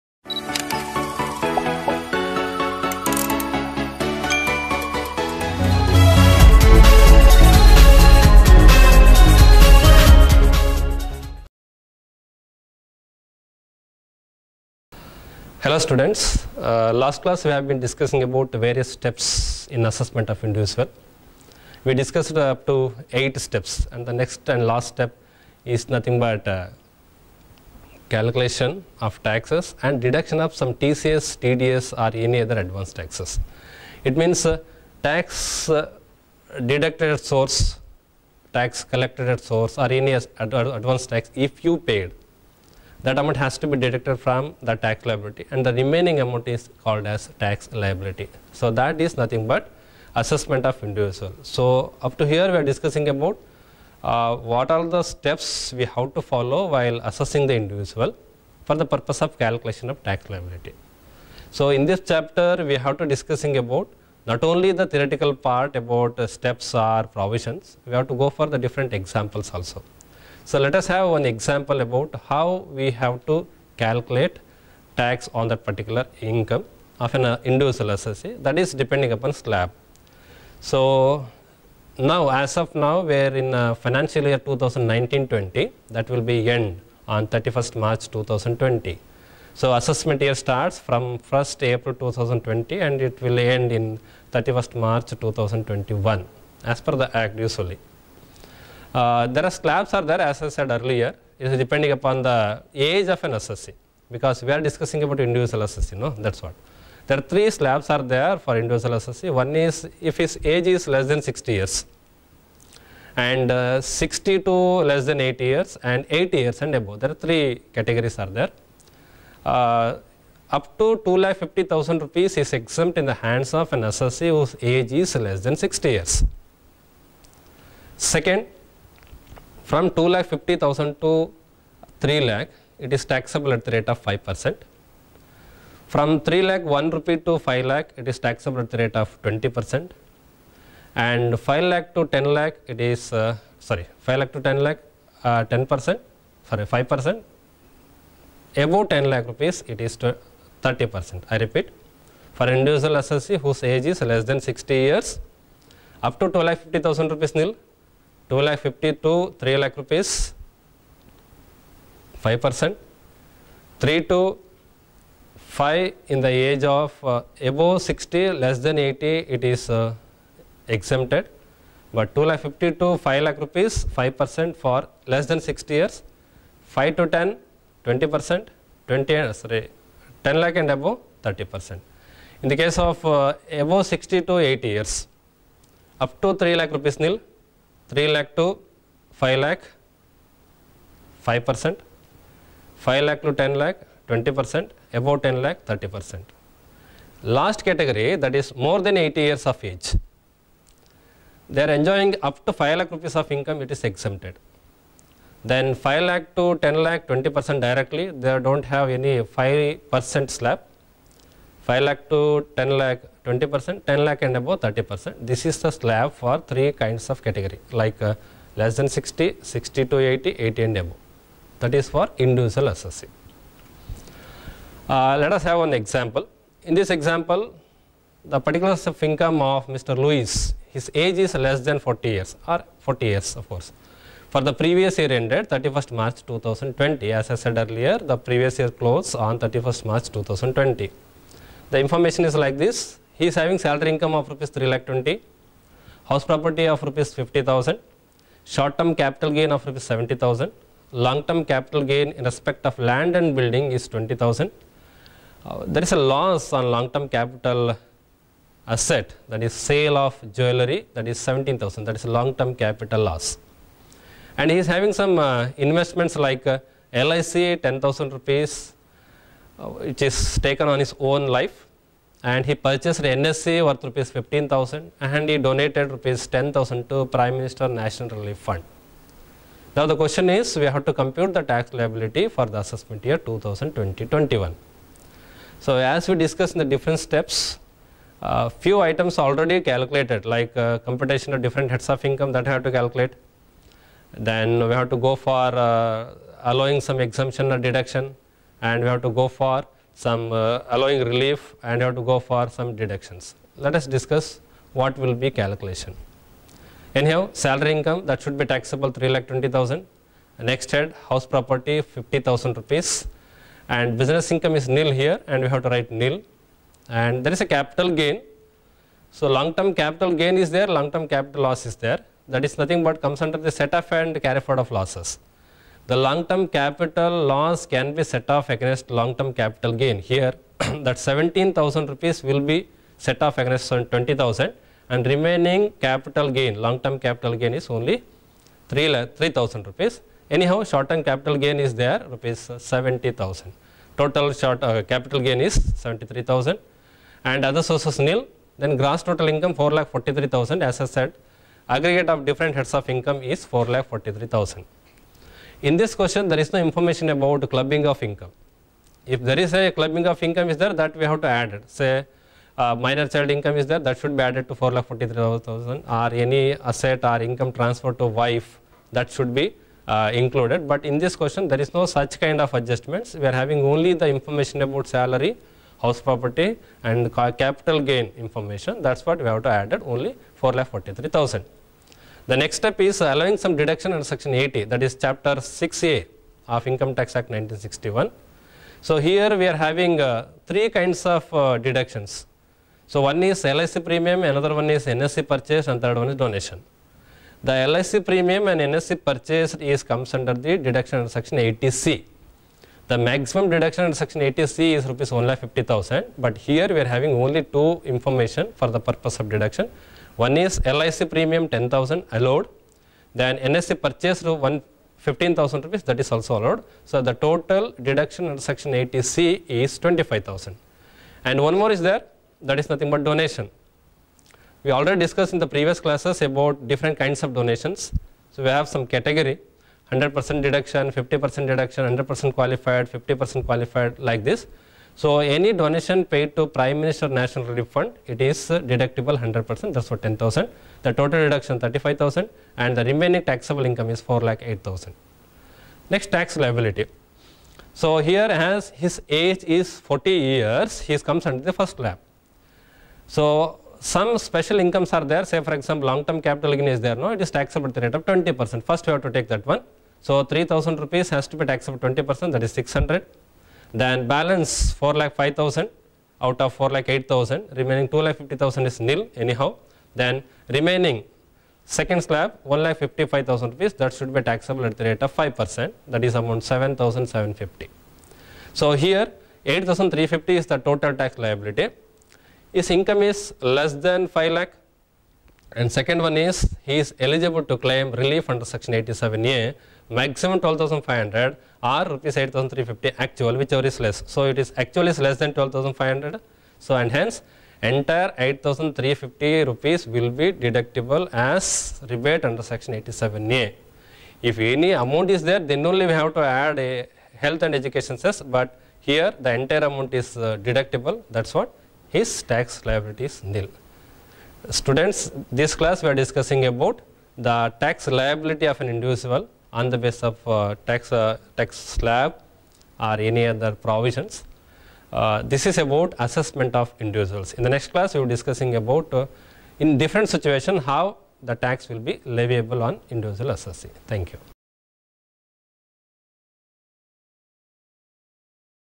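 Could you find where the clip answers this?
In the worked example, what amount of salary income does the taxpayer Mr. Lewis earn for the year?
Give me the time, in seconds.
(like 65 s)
244 s.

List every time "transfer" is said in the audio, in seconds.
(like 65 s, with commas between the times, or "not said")
367 s.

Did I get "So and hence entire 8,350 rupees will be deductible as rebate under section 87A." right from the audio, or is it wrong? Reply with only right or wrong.
right.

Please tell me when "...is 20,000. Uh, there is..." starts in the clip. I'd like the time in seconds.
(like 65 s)
253 s.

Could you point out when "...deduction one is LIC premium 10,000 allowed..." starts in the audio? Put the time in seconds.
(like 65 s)
409 s.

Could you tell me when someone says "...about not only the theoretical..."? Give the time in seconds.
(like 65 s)
63 s.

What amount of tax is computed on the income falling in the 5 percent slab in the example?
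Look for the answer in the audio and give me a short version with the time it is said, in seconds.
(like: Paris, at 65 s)
7,750, at 476 s.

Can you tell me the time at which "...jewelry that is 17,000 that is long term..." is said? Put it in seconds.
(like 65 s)
260 s.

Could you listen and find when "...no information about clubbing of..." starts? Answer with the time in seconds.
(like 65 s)
356 s.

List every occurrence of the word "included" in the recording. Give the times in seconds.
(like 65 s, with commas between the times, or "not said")
370 s.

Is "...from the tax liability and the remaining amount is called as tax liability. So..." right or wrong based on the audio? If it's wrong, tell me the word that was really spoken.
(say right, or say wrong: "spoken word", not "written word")
right.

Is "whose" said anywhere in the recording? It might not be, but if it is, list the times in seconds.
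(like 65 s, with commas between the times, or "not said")
124 s, 153 s.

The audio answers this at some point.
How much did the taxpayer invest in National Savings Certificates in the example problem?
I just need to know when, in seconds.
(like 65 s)
273 s.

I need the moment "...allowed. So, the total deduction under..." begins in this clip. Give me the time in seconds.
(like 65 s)
416 s.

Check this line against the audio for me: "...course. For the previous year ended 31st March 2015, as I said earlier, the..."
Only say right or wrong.
wrong.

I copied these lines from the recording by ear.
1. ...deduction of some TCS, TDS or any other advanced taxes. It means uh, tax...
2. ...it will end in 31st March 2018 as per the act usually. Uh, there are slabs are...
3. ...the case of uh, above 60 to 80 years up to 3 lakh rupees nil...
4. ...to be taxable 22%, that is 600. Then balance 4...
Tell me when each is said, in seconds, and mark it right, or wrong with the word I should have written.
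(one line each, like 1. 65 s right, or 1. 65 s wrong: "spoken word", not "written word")
1. 30 s right
2. 93 s wrong: "2021", not "2018"
3. 182 s right
4. 461 s wrong: "20", not "22".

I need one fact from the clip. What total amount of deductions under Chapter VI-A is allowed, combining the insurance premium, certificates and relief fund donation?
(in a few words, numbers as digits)
35,000.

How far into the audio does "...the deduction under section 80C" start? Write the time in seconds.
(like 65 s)
400 s.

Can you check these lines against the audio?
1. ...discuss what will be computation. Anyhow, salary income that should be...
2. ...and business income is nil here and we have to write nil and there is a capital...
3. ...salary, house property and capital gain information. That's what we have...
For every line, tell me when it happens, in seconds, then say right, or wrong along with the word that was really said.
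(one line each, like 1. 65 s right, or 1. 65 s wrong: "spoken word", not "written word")
1. 303 s wrong: "calculation", not "computation"
2. 313 s right
3. 374 s right.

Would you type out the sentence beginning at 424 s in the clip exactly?
We already discussed in the previous classes about different kinds of donations.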